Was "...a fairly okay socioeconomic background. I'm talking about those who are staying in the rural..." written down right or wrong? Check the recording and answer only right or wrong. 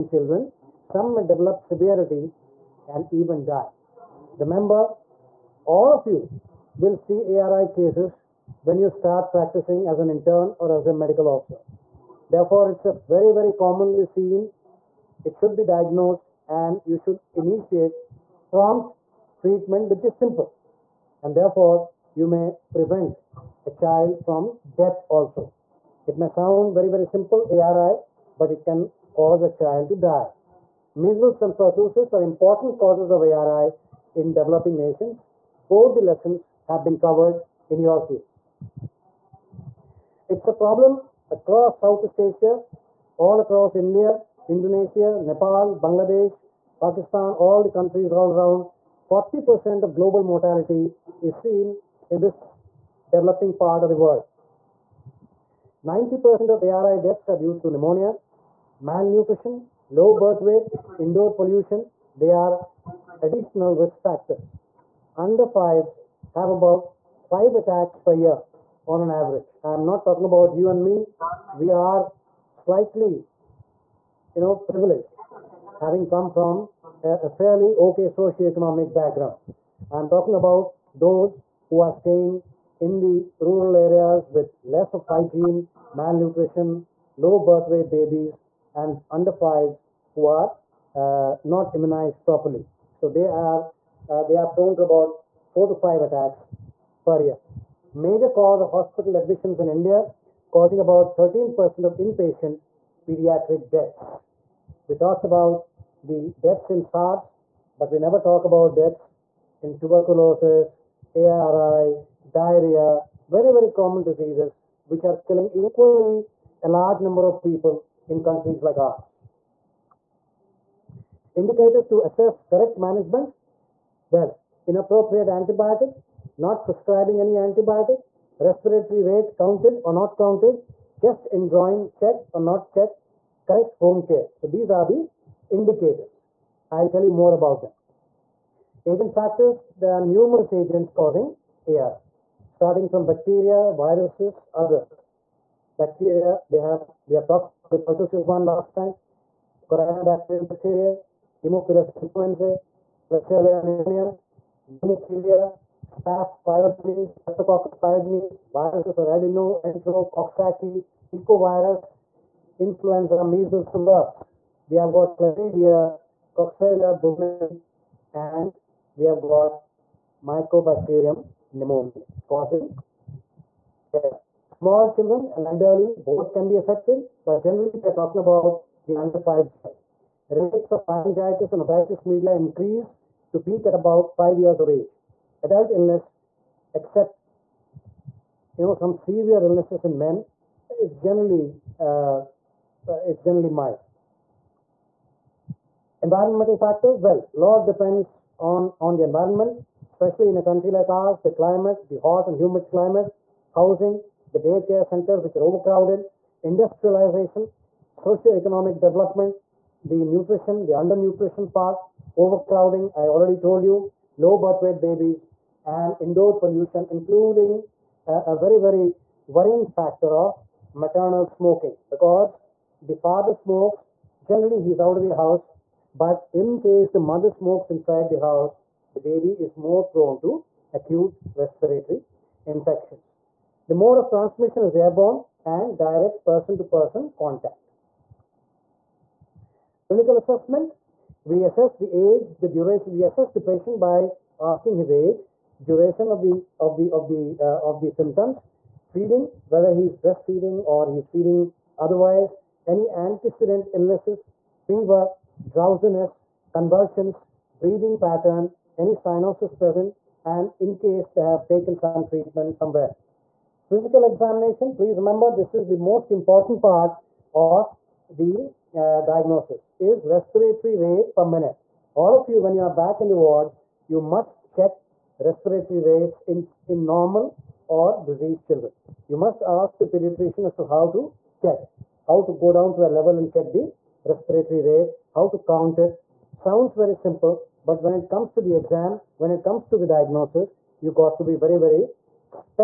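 right.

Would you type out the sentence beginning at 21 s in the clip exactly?
And therefore, you may prevent a child from death also.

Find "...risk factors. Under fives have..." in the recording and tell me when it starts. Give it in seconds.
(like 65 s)
63 s.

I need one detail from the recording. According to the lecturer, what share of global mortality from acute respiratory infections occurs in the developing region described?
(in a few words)
40%.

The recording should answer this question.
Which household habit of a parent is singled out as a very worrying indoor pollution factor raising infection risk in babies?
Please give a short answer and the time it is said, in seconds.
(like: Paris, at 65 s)
maternal smoking, at 220 s.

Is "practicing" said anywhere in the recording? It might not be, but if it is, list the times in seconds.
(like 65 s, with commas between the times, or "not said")
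9 s.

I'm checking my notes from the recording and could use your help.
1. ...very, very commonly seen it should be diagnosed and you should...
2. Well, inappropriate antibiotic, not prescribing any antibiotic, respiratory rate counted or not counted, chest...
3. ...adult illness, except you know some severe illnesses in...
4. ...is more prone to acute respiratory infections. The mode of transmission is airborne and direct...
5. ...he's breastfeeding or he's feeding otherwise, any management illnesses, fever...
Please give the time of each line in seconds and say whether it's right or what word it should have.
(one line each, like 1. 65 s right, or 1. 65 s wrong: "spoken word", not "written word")
1. 12 s right
2. 124 s right
3. 185 s right
4. 229 s right
5. 249 s wrong: "antecedent", not "management".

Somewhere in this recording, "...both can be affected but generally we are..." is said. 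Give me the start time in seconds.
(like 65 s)
176 s.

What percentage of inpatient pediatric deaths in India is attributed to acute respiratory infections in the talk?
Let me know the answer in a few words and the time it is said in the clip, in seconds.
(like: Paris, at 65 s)
13%, at 101 s.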